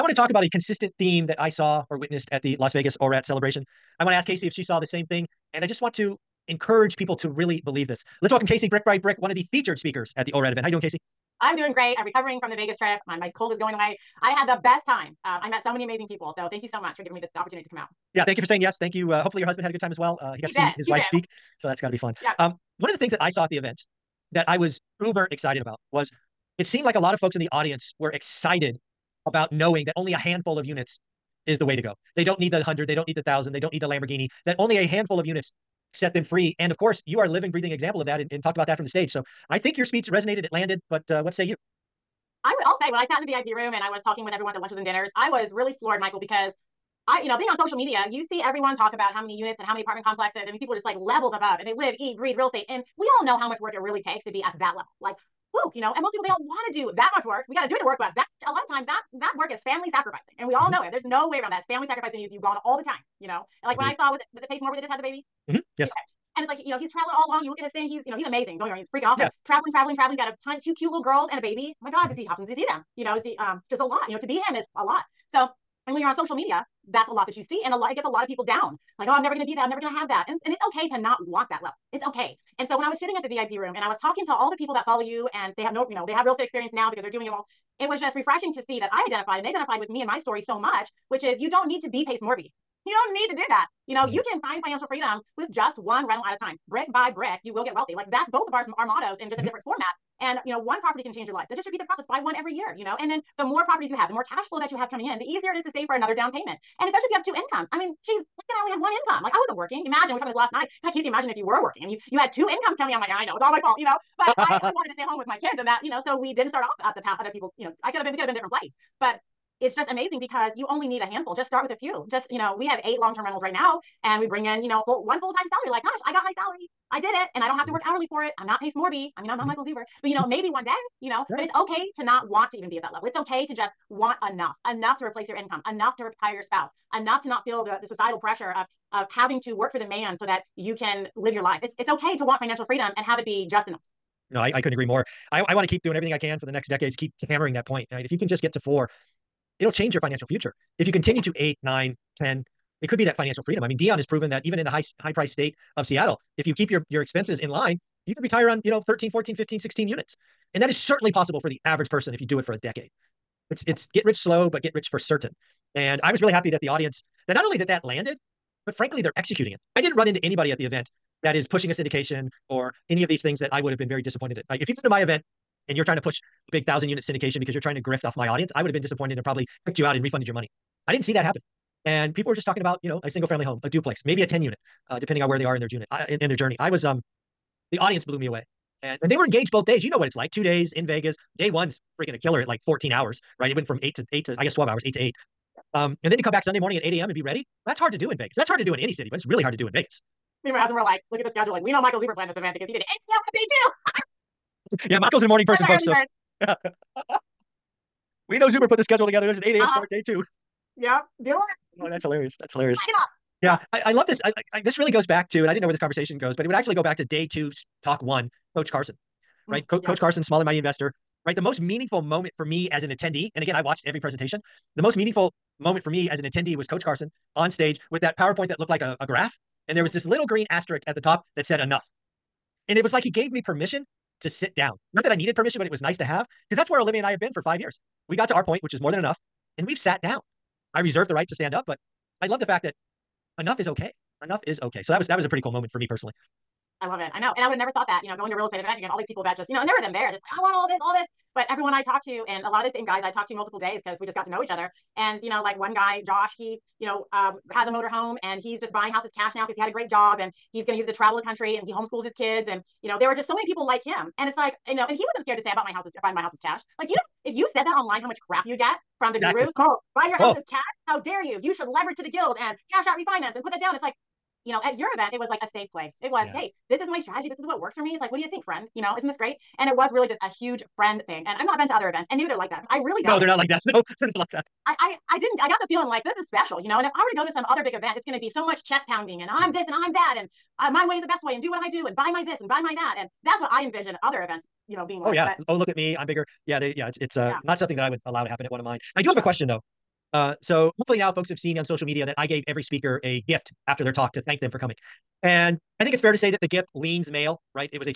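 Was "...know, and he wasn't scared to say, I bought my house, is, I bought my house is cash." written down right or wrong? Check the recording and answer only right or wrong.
right.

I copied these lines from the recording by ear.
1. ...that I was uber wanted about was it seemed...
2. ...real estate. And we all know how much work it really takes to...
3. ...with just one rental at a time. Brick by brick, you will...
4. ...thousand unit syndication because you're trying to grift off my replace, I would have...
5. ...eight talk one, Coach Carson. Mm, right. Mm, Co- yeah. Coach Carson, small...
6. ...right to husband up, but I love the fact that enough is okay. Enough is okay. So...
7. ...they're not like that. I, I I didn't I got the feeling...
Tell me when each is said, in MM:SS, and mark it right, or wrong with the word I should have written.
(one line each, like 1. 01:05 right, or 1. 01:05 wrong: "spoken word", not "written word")
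1. 00:24 wrong: "excited", not "wanted"
2. 00:52 right
3. 01:35 right
4. 02:56 wrong: "audience", not "replace"
5. 03:37 wrong: "two", not "eight"
6. 04:01 wrong: "stand", not "husband"
7. 04:43 right.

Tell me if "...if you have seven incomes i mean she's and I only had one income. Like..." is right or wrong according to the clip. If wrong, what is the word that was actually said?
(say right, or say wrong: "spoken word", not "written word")
wrong: "two", not "seven".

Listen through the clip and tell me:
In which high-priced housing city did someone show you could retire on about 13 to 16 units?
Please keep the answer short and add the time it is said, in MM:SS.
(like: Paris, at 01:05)
Seattle, at 02:35.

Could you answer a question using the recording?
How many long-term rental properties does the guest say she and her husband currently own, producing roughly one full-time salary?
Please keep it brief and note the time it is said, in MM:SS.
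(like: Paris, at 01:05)
8, at 02:02.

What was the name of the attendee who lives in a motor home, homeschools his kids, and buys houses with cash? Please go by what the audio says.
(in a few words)
Josh.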